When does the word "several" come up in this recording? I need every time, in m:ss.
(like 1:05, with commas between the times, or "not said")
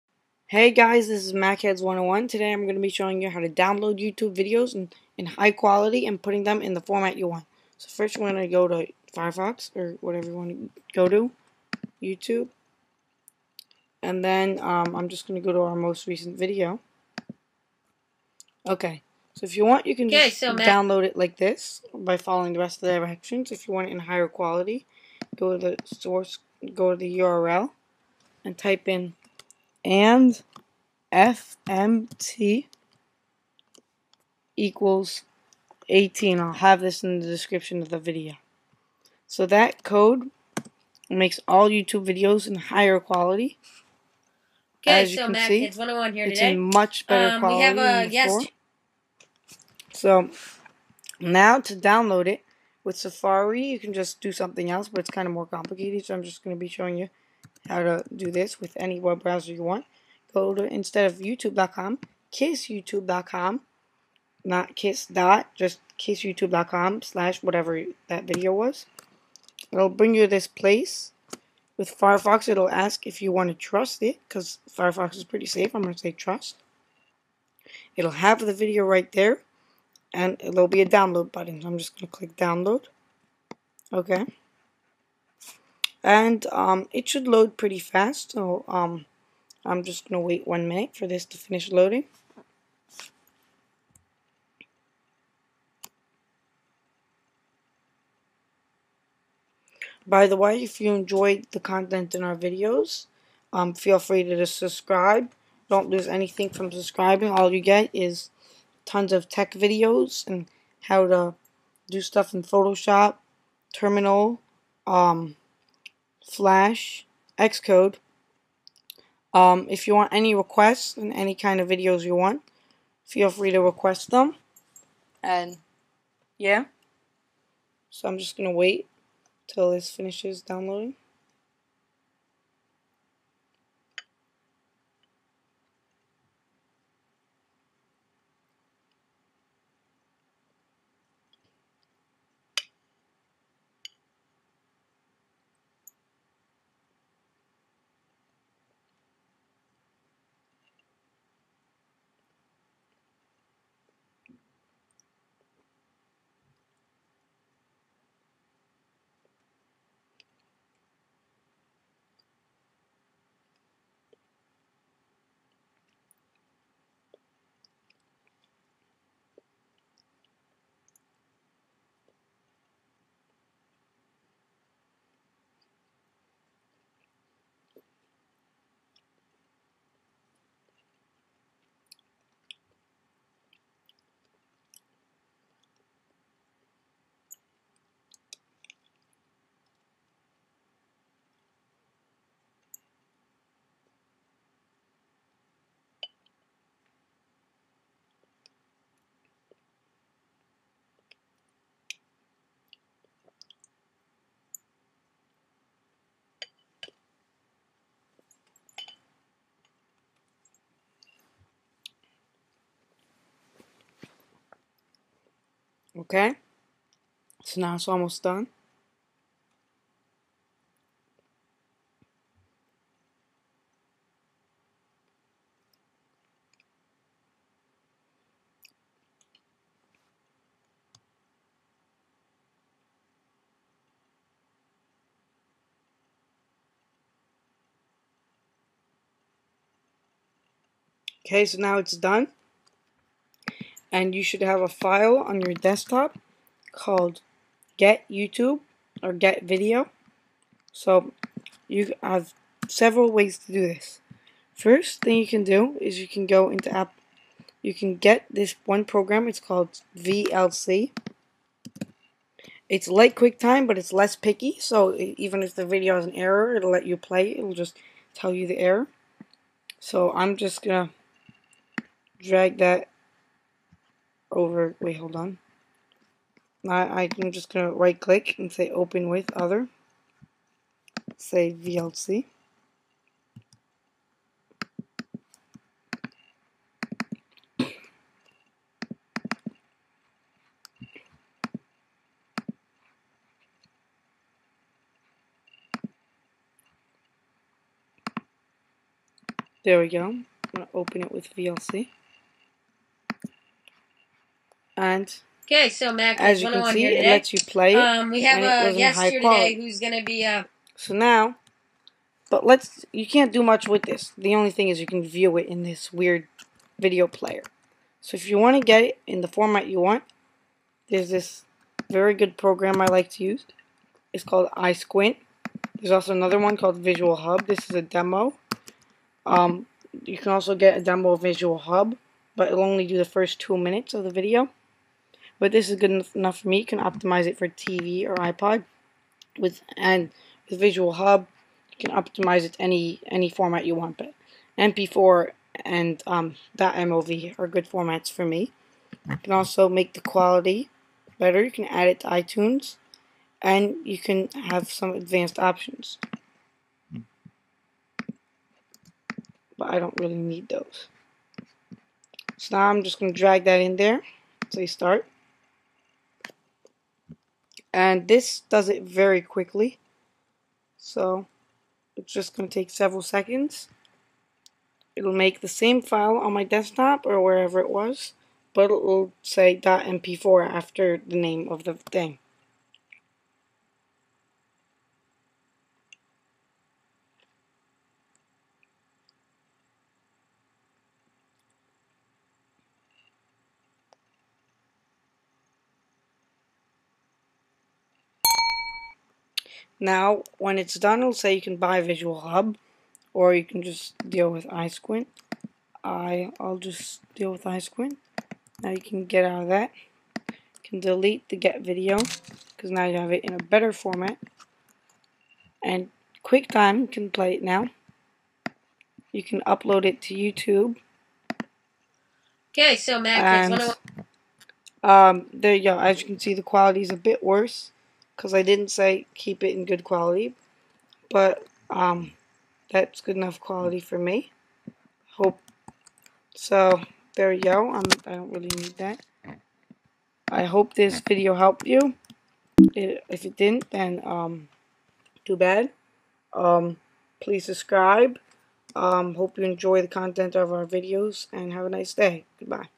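4:12, 6:12.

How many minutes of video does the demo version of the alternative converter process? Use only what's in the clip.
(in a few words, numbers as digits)
2.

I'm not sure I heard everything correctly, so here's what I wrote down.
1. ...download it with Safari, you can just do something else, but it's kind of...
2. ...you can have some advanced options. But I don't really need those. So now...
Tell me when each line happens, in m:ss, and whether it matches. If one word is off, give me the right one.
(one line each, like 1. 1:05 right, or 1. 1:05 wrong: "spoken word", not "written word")
1. 0:51 right
2. 5:53 right.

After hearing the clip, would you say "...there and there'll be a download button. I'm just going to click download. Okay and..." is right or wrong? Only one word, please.
right.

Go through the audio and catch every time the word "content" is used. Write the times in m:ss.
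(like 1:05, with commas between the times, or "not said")
1:41, 7:29.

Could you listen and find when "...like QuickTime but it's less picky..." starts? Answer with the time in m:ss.
4:22.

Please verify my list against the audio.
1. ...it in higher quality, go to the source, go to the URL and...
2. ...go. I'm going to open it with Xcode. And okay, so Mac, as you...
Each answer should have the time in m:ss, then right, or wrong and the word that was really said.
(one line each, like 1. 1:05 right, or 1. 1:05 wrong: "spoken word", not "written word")
1. 0:23 right
2. 4:59 wrong: "VLC", not "Xcode".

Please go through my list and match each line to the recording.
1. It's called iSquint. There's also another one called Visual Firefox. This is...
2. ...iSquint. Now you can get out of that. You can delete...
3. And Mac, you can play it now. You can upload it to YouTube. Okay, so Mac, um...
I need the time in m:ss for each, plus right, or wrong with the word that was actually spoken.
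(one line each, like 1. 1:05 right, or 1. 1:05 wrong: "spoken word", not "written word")
1. 5:24 wrong: "Hub", not "Firefox"
2. 6:47 right
3. 6:55 wrong: "QuickTime", not "Mac".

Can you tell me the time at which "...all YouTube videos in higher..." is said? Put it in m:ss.
0:41.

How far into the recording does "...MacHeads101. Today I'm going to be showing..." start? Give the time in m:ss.
0:01.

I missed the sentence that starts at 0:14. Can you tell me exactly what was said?
And then um, I'm just going to go to our most recent video.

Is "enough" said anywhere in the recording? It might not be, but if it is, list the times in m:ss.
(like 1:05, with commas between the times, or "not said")
5:36, 7:13.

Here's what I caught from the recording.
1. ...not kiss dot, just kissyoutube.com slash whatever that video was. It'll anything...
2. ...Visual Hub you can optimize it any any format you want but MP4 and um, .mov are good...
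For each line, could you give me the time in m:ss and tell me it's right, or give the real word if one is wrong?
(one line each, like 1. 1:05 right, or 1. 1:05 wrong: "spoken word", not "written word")
1. 1:04 wrong: "bring", not "anything"
2. 5:40 right.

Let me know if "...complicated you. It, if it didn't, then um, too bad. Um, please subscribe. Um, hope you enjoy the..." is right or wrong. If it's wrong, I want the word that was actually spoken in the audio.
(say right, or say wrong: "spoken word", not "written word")
wrong: "helped", not "complicated".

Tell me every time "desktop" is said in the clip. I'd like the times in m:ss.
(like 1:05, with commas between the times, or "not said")
4:05, 6:16.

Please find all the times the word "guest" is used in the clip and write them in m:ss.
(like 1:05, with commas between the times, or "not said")
0:48.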